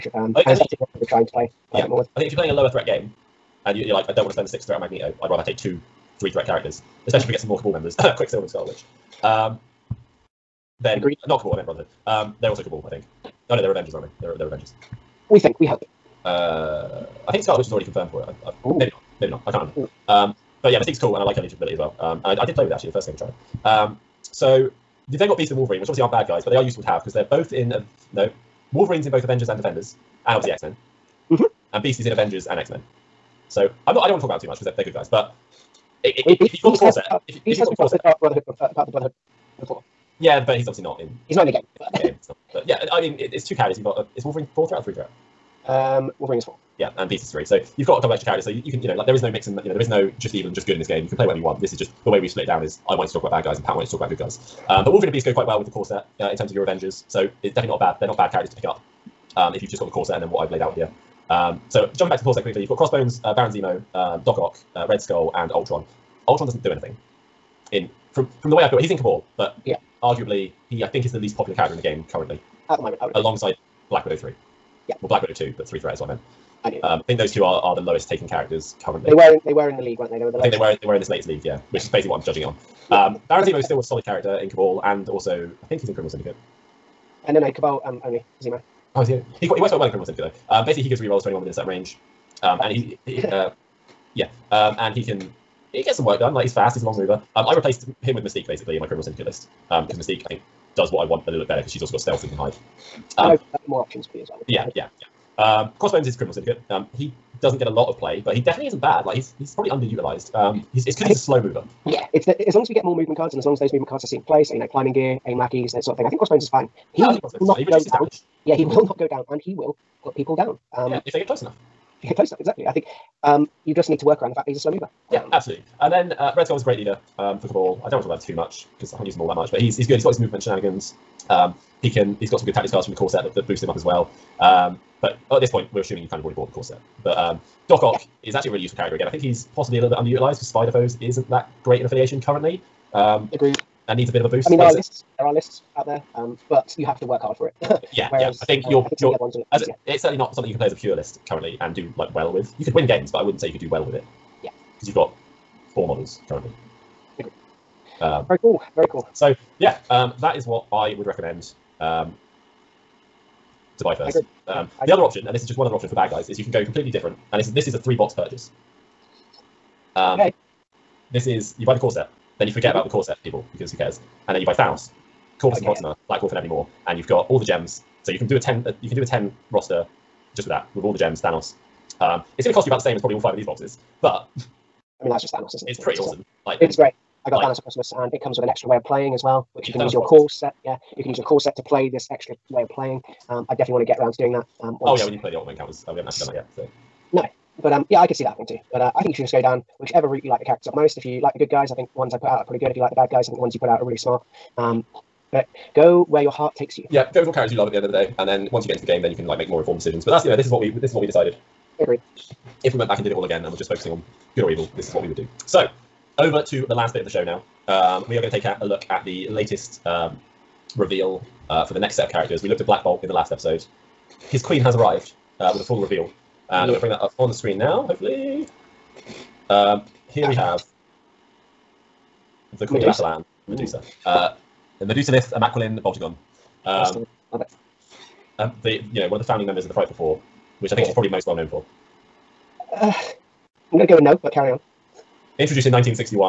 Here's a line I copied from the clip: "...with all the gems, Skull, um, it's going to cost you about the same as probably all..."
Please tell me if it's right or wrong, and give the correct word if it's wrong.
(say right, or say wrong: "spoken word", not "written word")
wrong: "Thanos", not "Skull".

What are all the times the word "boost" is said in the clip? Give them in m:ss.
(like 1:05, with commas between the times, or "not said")
2:13, 2:24.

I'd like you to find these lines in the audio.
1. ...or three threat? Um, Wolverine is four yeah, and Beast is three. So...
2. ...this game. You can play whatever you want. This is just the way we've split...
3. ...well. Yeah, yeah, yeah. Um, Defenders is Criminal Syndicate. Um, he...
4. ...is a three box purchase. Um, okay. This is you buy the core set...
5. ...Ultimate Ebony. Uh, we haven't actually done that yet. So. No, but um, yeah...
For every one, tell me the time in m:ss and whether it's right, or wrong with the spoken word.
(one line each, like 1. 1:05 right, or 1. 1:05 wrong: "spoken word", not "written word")
1. 0:44 right
2. 0:50 right
3. 1:44 wrong: "Crossbones", not "Defenders"
4. 2:47 right
5. 3:15 wrong: "Encounters", not "Ebony".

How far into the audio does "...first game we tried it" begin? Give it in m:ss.
0:22.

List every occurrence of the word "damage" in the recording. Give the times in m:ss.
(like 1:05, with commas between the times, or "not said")
1:57.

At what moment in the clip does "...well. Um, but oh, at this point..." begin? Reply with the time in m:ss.
2:13.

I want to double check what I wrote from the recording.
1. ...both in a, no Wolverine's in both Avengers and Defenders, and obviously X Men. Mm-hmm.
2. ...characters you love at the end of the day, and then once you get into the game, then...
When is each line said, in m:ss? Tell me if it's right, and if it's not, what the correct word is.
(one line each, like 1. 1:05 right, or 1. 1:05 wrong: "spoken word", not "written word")
1. 0:27 right
2. 3:27 right.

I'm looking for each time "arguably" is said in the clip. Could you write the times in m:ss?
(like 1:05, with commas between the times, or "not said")
1:10.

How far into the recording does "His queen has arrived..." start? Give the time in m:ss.
3:44.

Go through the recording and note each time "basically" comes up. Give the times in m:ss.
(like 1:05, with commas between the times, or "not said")
1:21, 1:30, 1:38.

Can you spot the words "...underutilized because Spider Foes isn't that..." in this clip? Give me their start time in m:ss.
2:19.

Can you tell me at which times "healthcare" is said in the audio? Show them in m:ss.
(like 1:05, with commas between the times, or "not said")
not said.